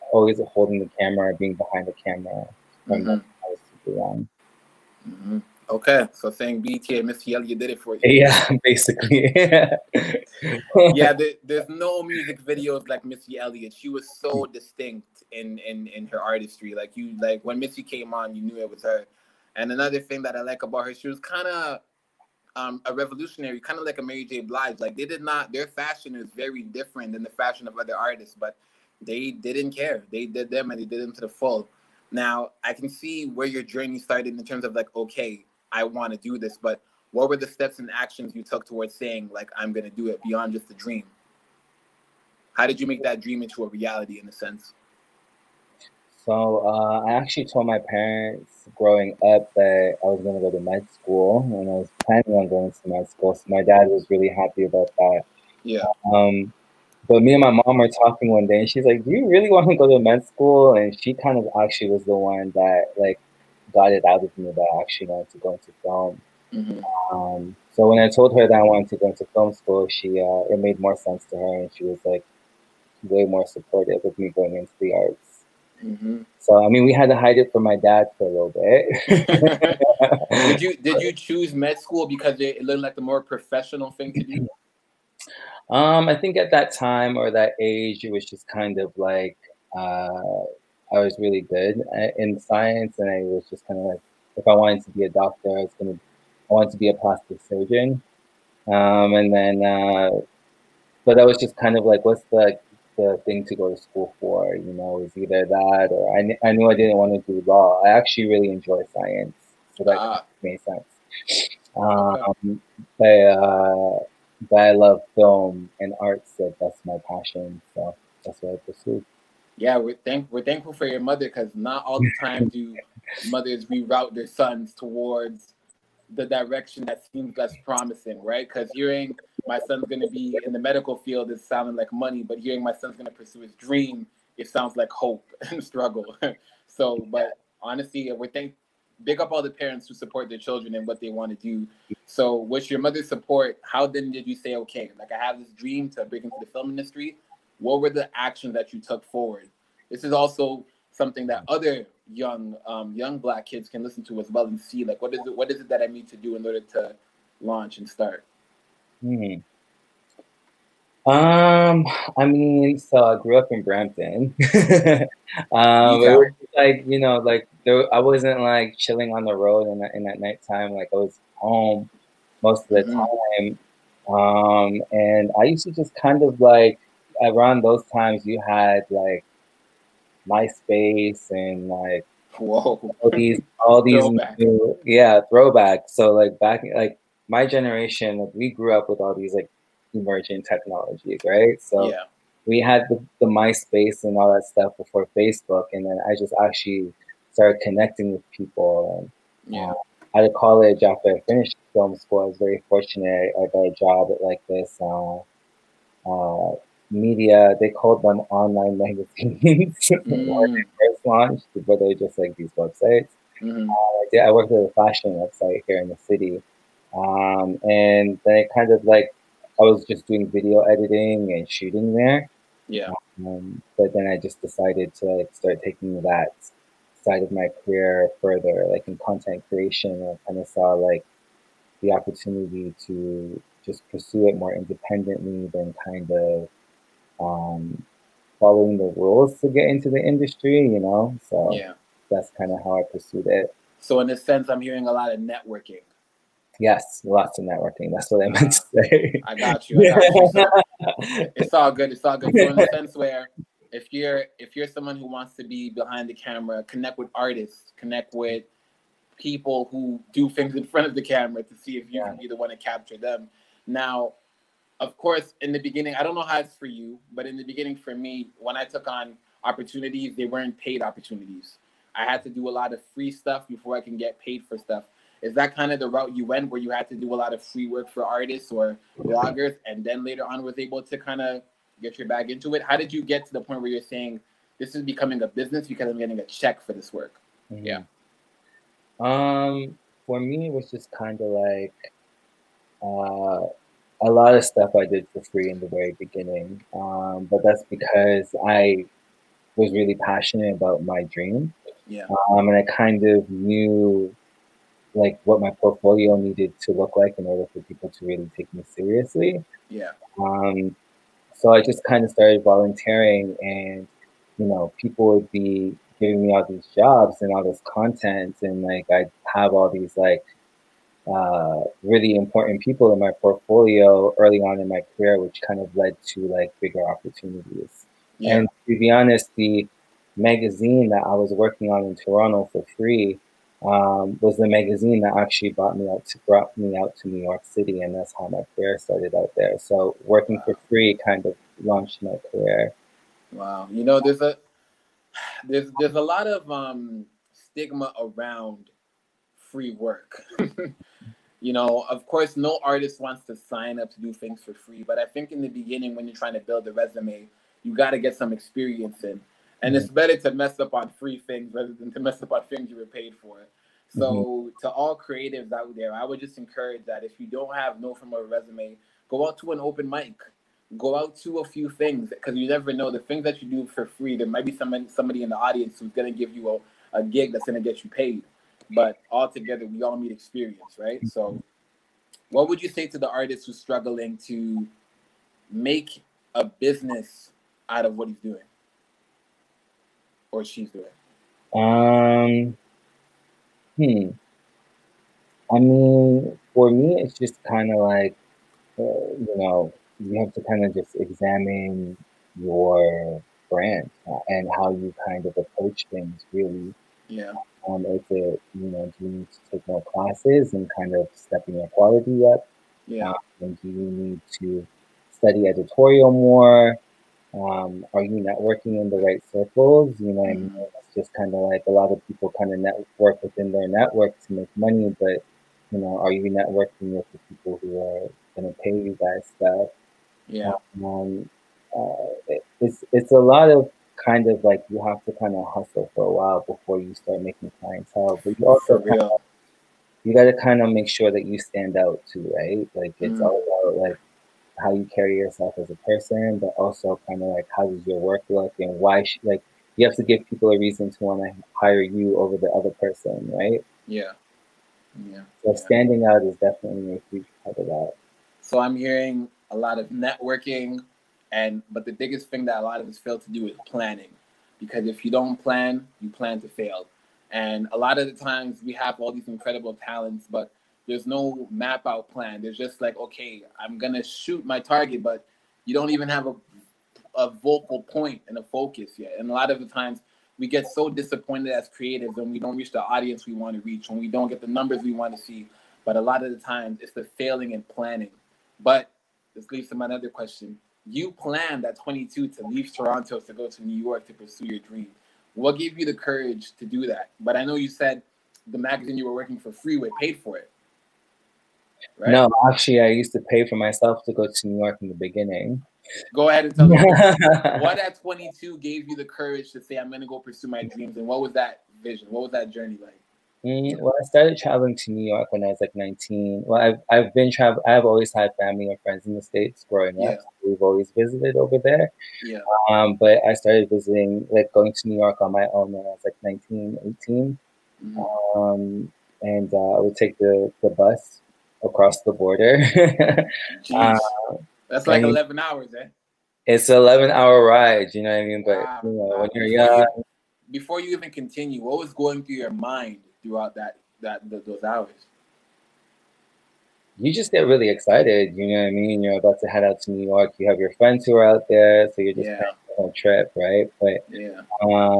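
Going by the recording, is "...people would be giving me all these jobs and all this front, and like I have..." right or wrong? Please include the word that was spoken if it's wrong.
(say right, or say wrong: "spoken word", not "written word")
wrong: "content", not "front".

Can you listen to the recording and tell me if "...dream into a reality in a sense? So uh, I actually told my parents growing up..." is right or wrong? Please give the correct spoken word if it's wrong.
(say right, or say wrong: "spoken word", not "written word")
right.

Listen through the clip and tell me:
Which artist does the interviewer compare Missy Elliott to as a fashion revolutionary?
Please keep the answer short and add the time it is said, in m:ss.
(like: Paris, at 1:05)
Mary J. Blige, at 0:24.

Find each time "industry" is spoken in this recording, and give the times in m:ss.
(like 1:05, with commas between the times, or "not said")
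2:26, 4:00.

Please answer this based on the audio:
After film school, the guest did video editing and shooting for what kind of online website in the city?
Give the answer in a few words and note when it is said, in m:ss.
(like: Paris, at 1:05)
a fashion website, at 3:34.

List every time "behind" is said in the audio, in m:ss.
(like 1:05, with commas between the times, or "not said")
0:01, 4:15.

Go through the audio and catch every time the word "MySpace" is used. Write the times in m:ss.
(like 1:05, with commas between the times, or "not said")
3:00, 3:13.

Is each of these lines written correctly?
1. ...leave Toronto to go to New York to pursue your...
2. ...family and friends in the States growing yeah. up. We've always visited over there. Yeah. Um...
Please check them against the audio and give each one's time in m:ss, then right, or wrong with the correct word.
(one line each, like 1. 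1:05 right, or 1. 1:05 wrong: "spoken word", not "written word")
1. 8:12 right
2. 8:38 right.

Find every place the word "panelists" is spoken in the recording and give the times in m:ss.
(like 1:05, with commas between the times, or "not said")
not said.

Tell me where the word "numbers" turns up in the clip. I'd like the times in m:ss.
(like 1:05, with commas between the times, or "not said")
8:04.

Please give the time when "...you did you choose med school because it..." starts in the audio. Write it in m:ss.
1:20.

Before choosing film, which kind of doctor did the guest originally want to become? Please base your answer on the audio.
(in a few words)
plastic surgeon.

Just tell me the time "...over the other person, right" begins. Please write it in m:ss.
7:32.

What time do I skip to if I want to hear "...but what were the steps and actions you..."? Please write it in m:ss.
0:36.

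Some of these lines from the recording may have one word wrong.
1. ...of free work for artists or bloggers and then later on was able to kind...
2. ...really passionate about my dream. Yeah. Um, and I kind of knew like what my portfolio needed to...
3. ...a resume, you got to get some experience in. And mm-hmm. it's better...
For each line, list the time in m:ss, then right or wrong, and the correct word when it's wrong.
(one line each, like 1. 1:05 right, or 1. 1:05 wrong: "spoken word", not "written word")
1. 4:37 right
2. 4:59 right
3. 5:56 right.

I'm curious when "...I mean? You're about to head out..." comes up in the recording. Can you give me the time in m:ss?
9:08.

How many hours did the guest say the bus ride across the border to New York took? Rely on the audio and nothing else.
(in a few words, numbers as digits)
11.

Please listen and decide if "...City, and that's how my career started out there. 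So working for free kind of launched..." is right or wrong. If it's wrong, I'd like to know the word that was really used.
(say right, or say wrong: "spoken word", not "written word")
right.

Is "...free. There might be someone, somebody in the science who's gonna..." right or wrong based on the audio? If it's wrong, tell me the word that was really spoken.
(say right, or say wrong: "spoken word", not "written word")
wrong: "audience", not "science".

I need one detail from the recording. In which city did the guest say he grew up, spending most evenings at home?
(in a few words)
Brampton.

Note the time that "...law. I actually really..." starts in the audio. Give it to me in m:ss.
1:47.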